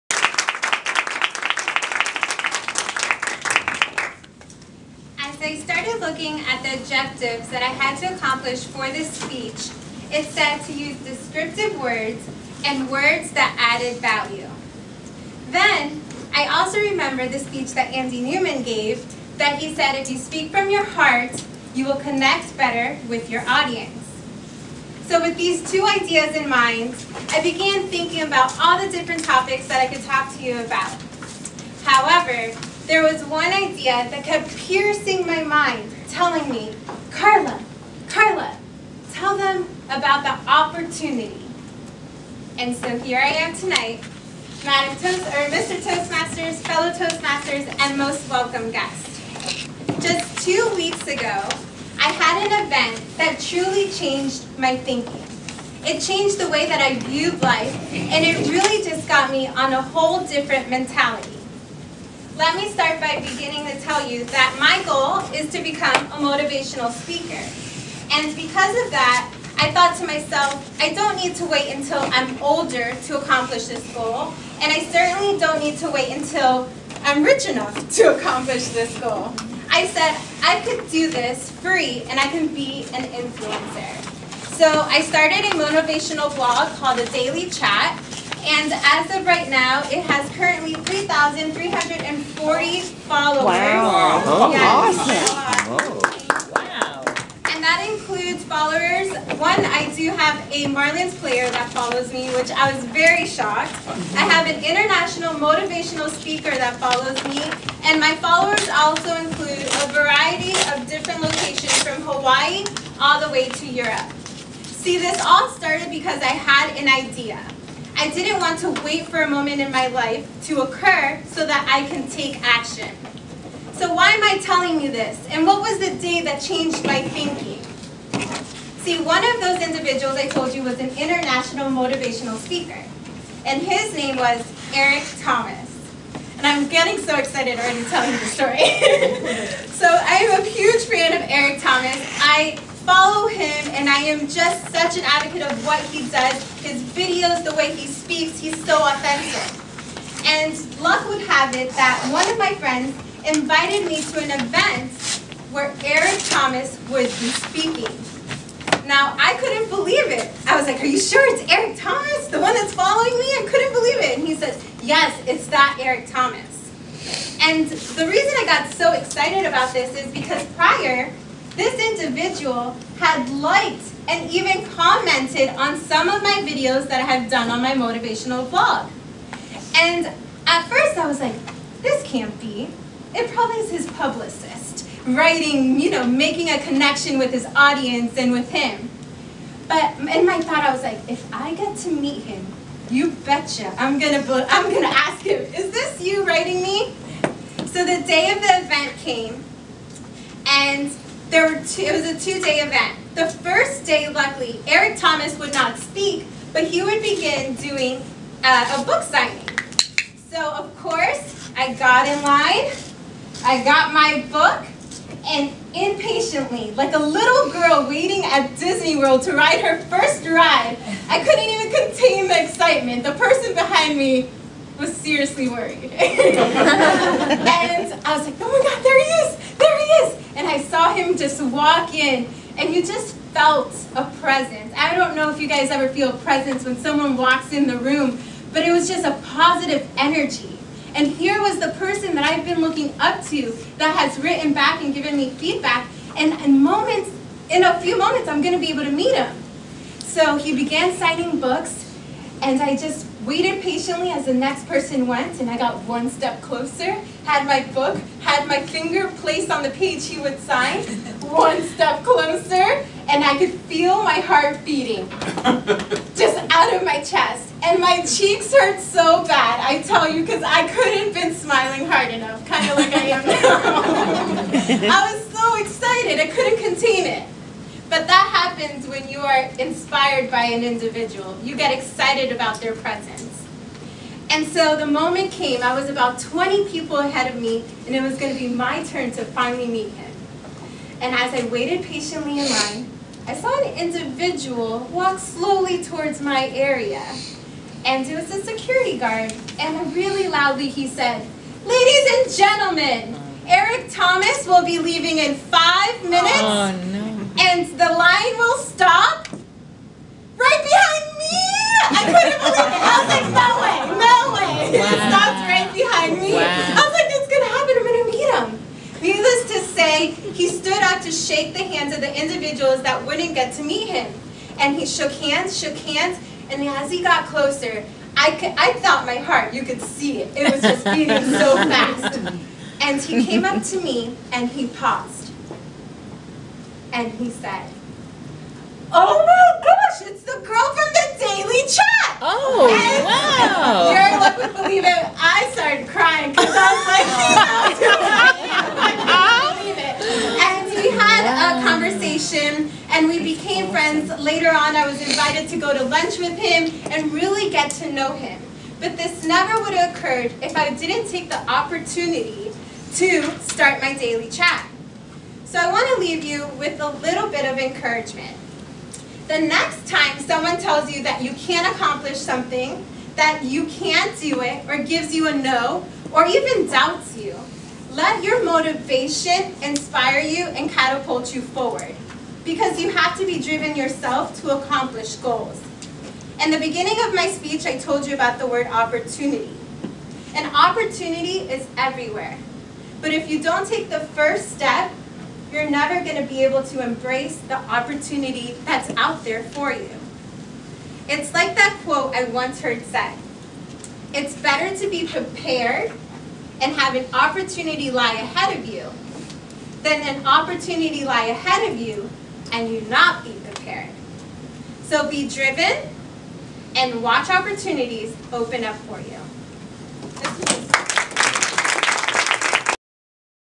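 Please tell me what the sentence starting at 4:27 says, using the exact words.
And my cheeks hurt so bad, I tell you, because I couldn't been smiling hard enough, kind of like I am now.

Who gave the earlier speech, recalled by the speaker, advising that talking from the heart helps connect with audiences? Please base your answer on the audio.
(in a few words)
Andy Newman.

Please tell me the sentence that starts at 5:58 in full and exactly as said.
But this never would have occurred if I didn't take the opportunity to start my daily chat.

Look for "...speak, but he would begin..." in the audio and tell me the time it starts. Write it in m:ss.
3:25.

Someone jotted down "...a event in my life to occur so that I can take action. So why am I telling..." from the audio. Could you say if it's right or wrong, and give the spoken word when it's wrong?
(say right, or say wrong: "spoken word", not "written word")
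wrong: "moment", not "event".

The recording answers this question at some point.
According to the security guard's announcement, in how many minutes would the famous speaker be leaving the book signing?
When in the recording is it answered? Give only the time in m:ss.
5:05.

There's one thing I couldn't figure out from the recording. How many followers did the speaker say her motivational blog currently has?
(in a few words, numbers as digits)
3340.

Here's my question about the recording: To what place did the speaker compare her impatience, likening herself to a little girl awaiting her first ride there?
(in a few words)
Disney World.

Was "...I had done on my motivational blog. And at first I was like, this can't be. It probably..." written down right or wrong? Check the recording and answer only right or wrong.
right.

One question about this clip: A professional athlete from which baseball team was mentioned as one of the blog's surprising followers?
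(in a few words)
Marlins.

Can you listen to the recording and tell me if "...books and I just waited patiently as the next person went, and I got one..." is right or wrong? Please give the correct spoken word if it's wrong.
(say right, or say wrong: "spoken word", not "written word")
right.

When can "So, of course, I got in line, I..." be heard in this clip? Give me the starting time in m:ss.
3:30.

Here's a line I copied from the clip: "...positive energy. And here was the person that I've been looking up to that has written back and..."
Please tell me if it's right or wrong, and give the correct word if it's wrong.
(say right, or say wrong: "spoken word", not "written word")
right.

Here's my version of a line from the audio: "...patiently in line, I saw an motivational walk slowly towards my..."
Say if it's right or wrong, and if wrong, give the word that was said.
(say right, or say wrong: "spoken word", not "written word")
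wrong: "individual", not "motivational".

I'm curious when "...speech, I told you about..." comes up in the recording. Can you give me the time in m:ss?
6:27.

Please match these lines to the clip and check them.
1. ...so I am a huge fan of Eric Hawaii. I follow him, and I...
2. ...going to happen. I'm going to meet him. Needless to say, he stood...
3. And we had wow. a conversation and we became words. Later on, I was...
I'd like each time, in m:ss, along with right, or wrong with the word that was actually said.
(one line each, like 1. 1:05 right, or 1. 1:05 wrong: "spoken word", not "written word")
1. 2:19 wrong: "Thomas", not "Hawaii"
2. 5:17 right
3. 5:50 wrong: "friends", not "words".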